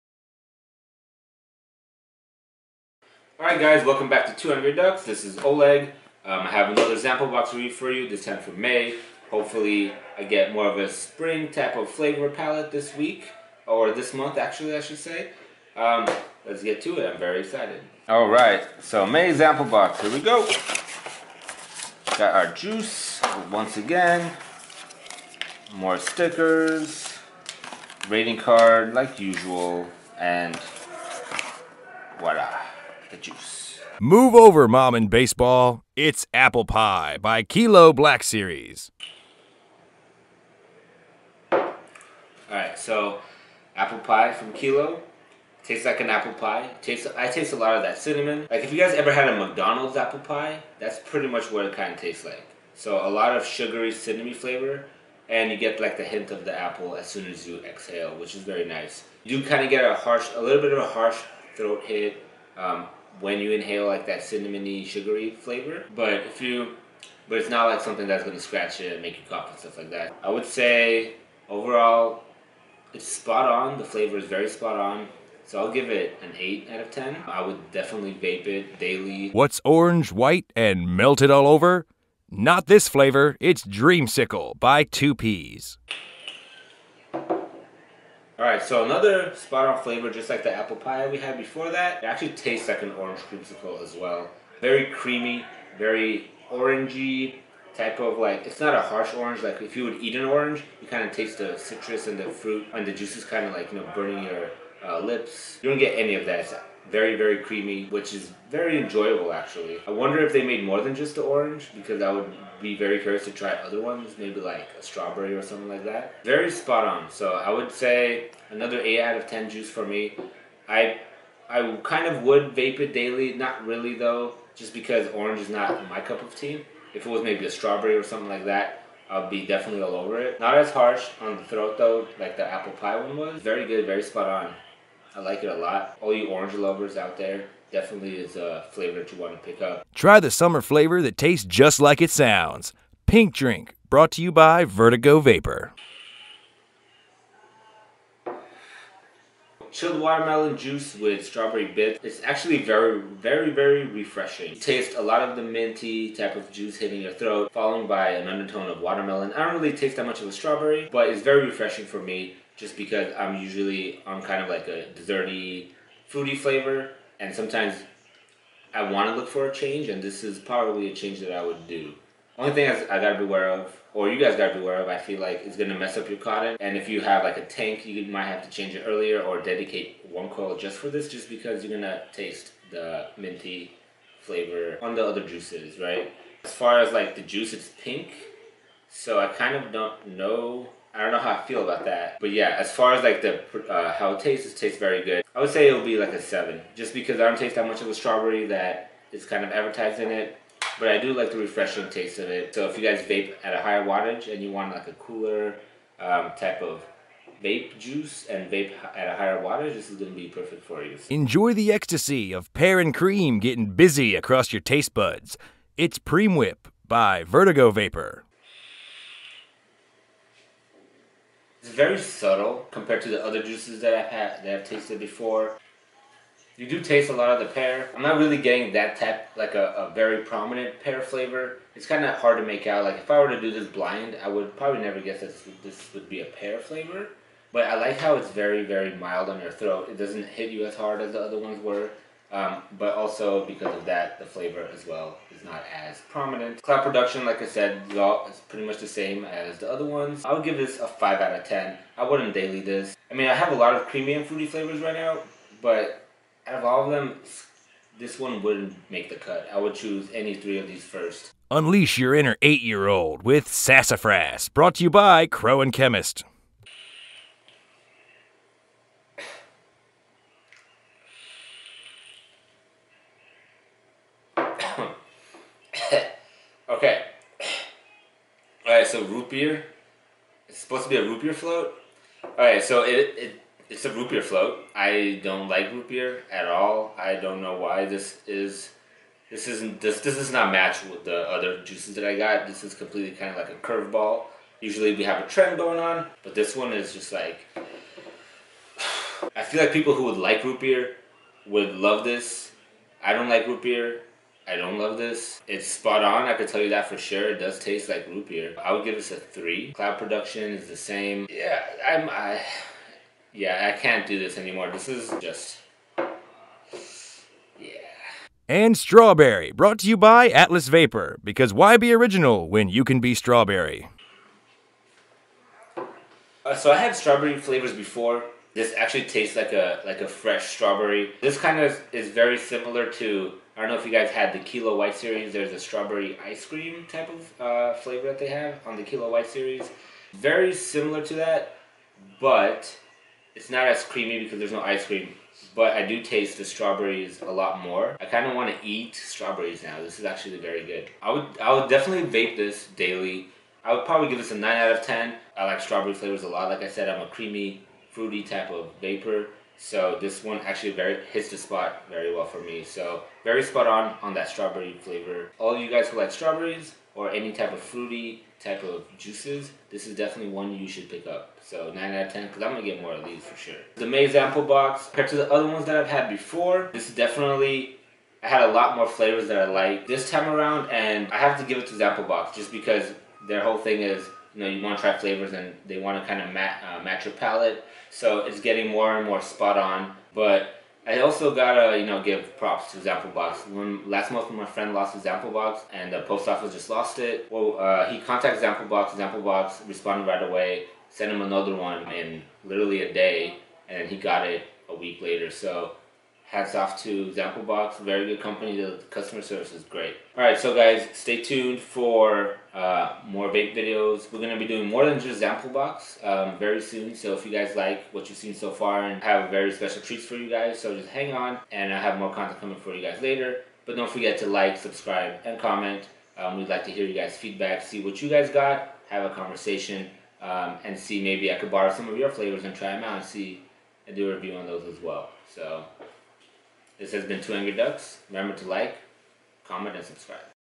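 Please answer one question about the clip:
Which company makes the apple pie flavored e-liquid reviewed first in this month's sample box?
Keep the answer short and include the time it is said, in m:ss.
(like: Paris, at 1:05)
Kilo Black Series, at 0:37.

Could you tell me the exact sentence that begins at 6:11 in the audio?
So 9 out of 10 because I'm going to get more of these for sure.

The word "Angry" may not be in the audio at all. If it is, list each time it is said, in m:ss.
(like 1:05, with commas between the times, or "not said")
0:04, 7:17.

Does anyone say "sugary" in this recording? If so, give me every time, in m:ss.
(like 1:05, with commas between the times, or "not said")
0:53, 1:04.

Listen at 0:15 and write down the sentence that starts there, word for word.
Um, let's get to it, I'm very excited.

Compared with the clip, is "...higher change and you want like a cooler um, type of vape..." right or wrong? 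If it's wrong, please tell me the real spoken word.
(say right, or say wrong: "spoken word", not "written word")
wrong: "wattage", not "change".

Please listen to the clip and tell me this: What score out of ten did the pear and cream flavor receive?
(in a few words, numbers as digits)
5.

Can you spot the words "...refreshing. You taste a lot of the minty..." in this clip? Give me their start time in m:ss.
2:33.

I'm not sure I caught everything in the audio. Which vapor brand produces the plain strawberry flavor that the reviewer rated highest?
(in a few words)
Atlas Vapor.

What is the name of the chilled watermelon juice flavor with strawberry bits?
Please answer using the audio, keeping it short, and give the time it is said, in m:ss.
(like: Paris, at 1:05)
Pink Drink, at 2:23.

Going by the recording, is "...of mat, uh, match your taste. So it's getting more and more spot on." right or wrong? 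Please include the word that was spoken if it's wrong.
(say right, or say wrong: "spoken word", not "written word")
wrong: "palate", not "taste".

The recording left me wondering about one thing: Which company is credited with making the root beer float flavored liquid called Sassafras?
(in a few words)
Crow and Chemist.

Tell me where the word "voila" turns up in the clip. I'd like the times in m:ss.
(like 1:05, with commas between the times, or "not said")
0:32.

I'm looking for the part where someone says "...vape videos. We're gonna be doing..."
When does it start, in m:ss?
6:53.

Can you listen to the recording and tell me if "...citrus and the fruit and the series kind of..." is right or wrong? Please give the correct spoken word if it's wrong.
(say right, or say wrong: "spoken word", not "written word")
wrong: "juices", not "series".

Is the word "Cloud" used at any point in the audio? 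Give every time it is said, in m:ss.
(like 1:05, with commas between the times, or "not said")
4:06, 5:09.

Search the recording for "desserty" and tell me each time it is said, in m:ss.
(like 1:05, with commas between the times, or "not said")
2:44.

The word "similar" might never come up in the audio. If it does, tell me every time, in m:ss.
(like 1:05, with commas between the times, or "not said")
5:32, 5:40.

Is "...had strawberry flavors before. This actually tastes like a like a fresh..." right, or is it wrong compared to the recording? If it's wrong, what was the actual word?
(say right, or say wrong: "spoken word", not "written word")
right.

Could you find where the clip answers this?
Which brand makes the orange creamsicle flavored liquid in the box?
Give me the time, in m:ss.
1:24.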